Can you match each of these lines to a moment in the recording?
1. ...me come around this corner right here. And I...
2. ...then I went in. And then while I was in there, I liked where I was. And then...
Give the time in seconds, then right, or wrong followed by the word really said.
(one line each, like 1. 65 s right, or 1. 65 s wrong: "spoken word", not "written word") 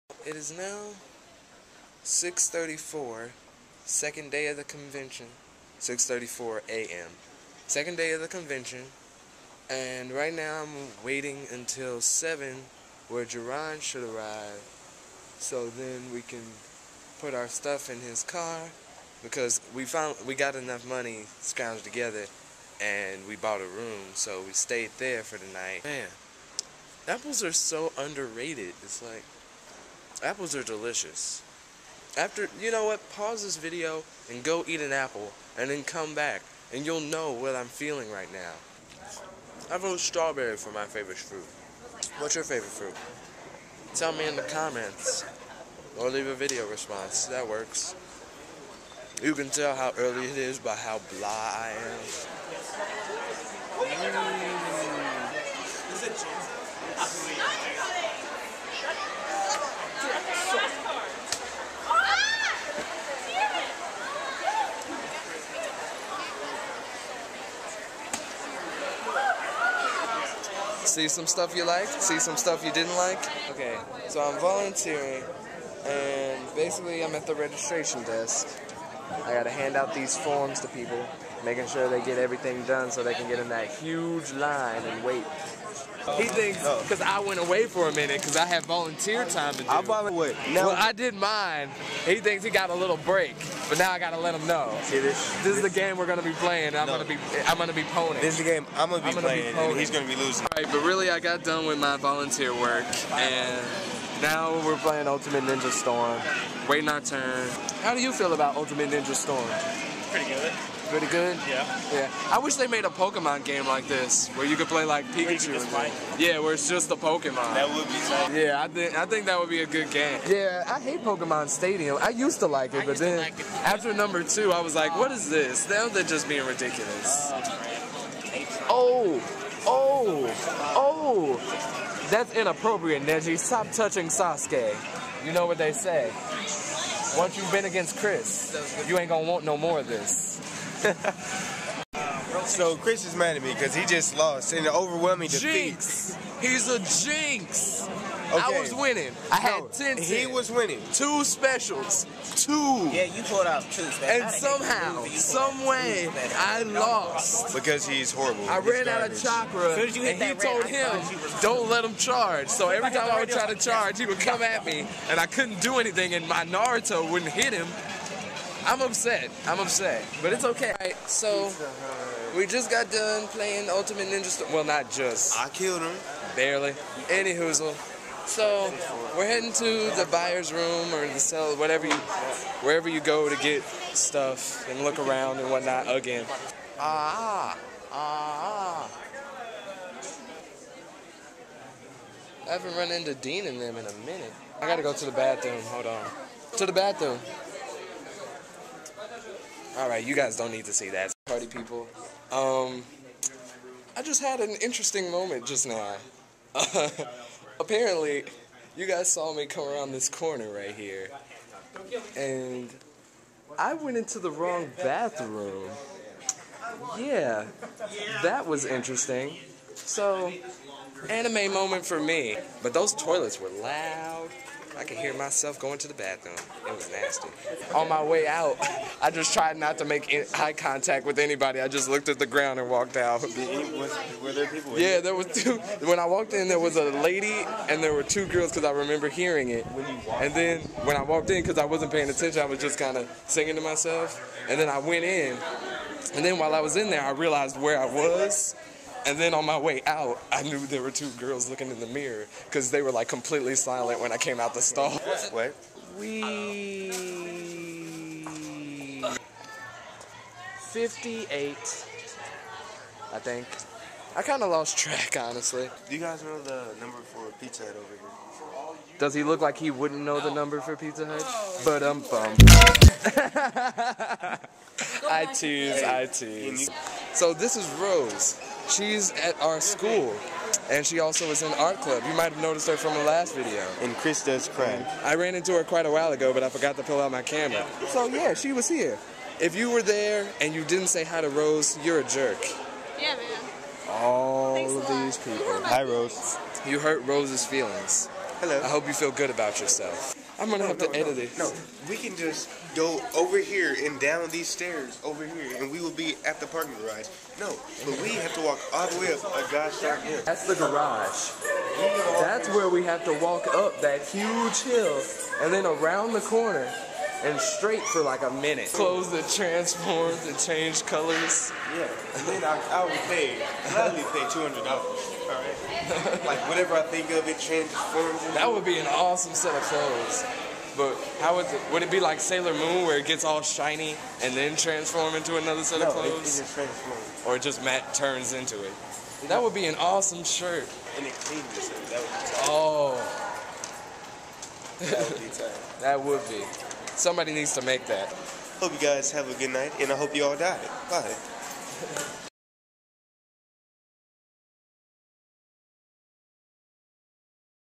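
1. 209 s right
2. 244 s wrong: "realized", not "liked".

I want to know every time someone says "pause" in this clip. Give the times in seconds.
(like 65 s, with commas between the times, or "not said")
33 s.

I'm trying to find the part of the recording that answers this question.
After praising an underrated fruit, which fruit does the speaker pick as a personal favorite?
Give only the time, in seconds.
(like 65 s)
39 s.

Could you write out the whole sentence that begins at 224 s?
I could hear myself going to the bathroom.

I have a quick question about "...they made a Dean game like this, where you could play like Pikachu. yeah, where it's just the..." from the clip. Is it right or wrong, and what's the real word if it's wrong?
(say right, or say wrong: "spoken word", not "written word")
wrong: "Pokemon", not "Dean".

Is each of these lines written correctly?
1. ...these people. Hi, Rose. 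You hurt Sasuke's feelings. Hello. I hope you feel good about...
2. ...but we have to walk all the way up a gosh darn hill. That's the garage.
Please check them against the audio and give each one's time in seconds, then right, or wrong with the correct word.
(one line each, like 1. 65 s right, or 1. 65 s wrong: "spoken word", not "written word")
1. 295 s wrong: "Rose", not "Sasuke"
2. 307 s right.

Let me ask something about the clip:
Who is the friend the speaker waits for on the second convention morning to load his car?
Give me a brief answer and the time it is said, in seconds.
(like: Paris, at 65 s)
Jaron, at 13 s.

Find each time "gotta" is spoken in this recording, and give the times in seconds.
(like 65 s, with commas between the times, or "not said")
79 s, 93 s, 194 s.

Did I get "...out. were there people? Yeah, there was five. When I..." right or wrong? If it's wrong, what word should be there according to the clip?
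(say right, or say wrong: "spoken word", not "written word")
wrong: "two", not "five".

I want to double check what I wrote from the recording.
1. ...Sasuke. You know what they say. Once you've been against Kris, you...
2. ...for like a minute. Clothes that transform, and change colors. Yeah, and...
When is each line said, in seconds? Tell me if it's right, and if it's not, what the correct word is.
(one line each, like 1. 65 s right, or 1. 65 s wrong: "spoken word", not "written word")
1. 134 s right
2. 317 s right.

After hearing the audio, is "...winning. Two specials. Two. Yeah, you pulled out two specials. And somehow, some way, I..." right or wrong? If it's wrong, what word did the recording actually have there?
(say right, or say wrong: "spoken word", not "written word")
right.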